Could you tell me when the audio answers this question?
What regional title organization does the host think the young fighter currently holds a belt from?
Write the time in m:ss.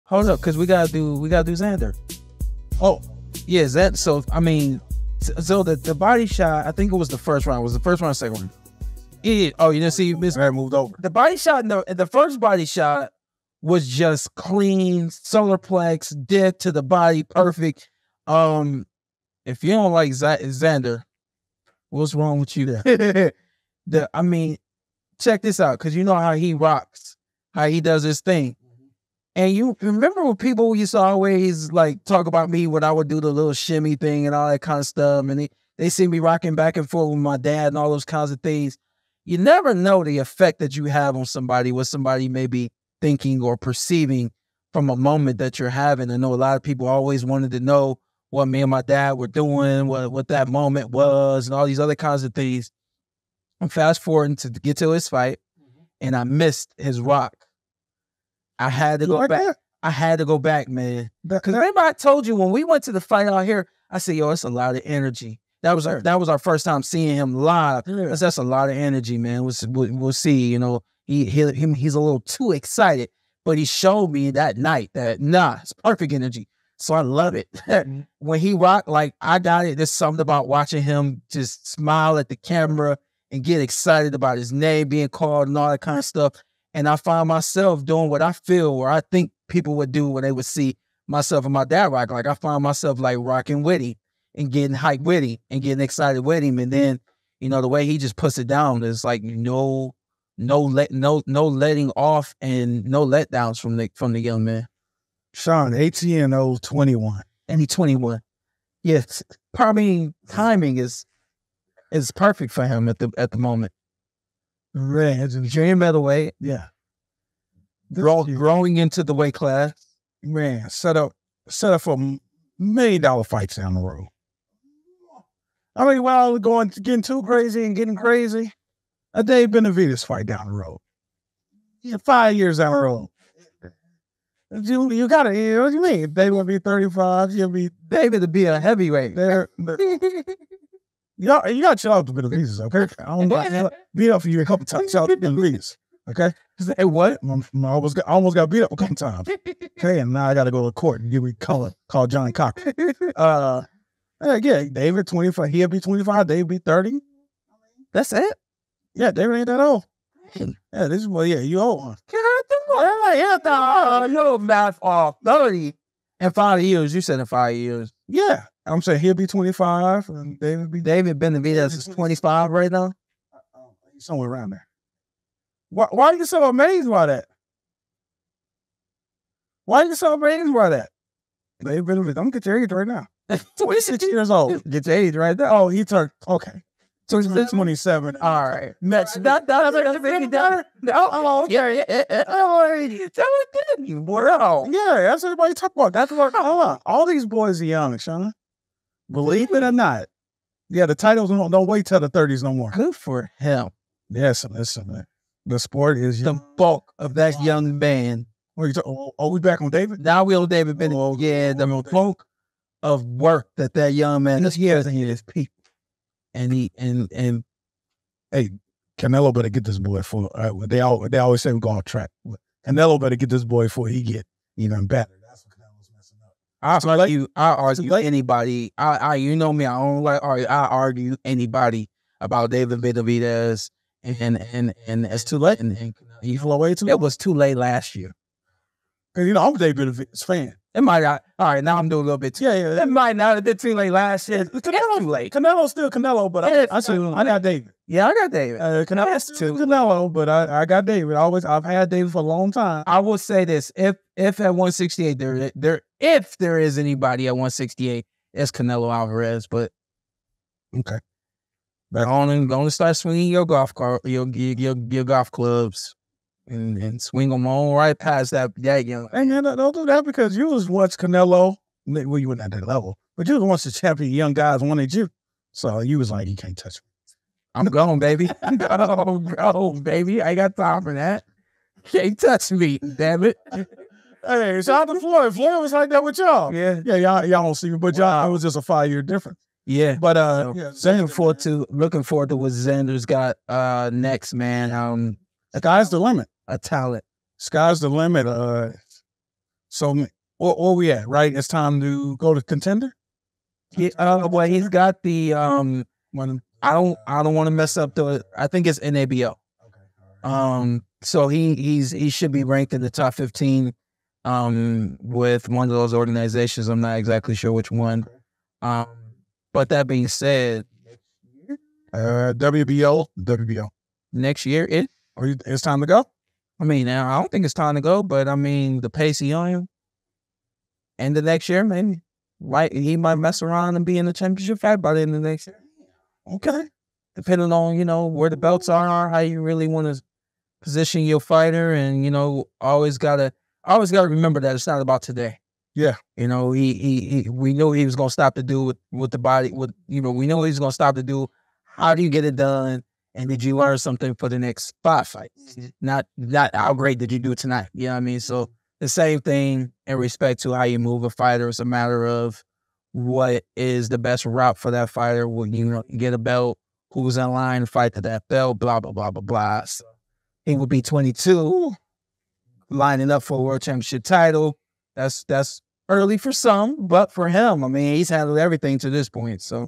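5:08.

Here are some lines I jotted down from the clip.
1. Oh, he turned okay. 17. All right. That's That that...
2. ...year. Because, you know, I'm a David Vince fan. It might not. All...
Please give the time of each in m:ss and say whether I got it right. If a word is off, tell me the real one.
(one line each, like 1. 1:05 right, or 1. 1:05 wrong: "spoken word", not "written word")
1. 3:05 wrong: "27", not "17"
2. 3:57 right.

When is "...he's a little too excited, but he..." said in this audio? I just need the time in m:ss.
1:11.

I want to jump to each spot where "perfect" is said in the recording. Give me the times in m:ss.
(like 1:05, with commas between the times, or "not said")
0:17, 1:15, 1:52.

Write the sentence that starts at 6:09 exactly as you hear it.
So he would be 22, lining up for a world championship title.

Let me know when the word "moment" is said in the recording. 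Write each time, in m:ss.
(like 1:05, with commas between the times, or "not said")
0:44, 0:50, 1:53.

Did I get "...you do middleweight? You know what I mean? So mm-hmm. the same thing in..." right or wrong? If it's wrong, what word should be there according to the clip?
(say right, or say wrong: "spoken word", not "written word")
wrong: "tonight", not "middleweight".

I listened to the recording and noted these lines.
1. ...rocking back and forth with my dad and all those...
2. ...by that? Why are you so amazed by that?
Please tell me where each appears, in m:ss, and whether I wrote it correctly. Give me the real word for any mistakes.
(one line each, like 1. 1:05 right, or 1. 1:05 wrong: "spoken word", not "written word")
1. 0:36 right
2. 2:56 right.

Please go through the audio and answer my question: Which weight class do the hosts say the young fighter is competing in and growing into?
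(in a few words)
Junior middleweight.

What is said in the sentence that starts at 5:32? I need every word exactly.
He might mess around and be in the championship fight by the end of the next year.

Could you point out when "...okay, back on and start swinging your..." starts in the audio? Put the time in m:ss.
4:20.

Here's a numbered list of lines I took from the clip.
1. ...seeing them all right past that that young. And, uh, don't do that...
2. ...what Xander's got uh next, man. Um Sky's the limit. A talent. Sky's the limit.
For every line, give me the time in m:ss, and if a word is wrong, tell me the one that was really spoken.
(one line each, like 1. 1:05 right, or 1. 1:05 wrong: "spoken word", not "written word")
1. 4:27 wrong: "swing", not "seeing"
2. 4:52 right.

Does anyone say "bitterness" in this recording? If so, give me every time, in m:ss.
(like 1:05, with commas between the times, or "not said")
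not said.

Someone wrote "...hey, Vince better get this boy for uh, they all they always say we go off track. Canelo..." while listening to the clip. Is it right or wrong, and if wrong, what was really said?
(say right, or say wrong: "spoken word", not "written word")
wrong: "Canelo", not "Vince".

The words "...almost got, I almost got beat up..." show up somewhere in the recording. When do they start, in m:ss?
2:27.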